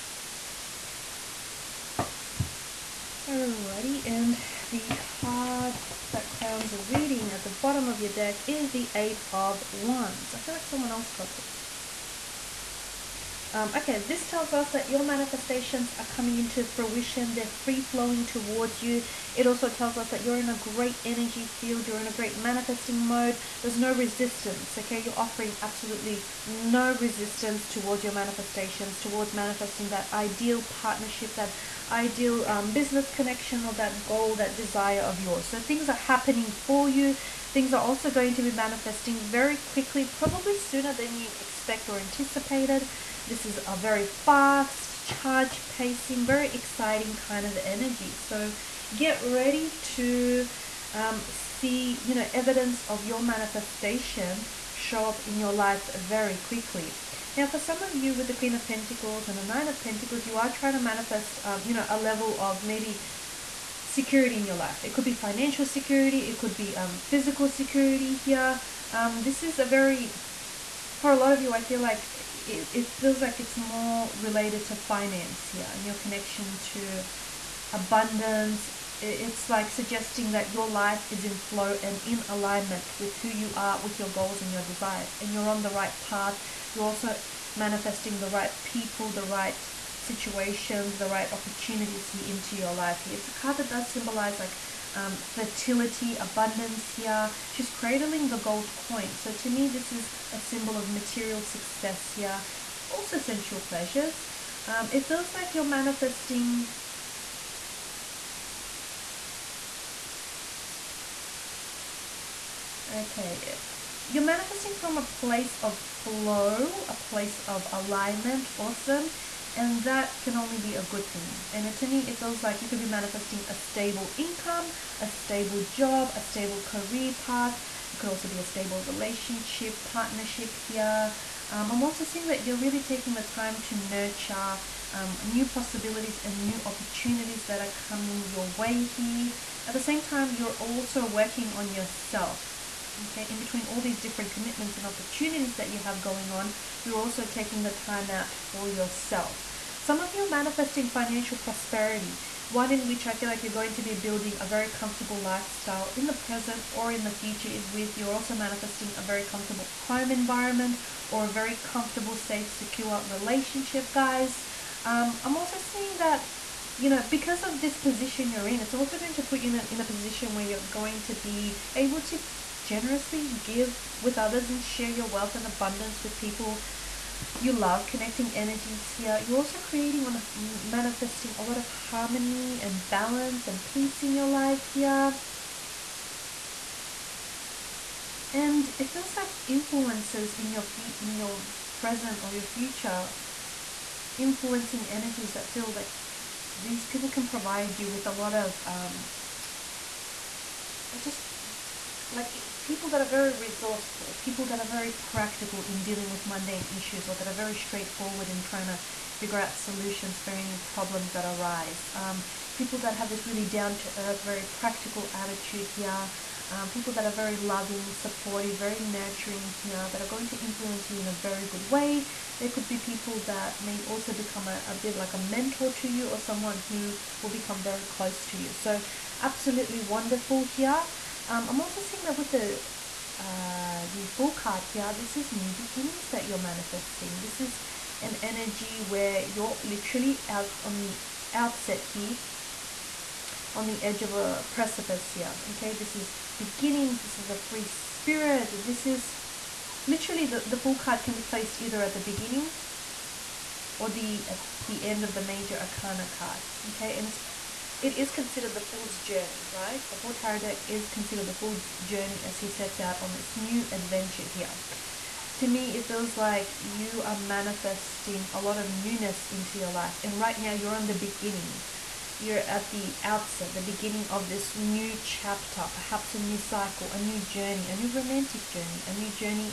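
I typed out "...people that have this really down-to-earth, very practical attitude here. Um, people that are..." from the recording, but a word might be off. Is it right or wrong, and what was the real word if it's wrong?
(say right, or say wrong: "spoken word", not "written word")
right.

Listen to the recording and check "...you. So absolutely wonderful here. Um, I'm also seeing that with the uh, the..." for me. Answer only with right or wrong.
right.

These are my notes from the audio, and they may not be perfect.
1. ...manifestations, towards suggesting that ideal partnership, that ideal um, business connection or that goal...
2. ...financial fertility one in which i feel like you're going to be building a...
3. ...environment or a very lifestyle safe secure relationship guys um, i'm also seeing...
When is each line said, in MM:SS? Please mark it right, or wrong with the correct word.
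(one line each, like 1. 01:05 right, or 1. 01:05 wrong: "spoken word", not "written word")
1. 00:28 wrong: "manifesting", not "suggesting"
2. 02:30 wrong: "prosperity", not "fertility"
3. 02:40 wrong: "comfortable", not "lifestyle".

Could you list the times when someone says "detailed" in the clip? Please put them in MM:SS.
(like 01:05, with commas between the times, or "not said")
not said.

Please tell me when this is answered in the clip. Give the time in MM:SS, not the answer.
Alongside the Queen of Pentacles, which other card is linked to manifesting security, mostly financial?
00:59.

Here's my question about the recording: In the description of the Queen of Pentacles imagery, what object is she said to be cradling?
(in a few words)
gold coin.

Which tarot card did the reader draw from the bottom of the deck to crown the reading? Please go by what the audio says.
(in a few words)
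Eight of Wands.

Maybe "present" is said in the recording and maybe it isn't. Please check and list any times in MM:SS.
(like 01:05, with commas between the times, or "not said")
02:36, 03:11.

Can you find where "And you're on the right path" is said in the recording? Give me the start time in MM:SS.
01:25.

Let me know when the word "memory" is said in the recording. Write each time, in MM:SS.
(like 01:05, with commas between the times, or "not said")
not said.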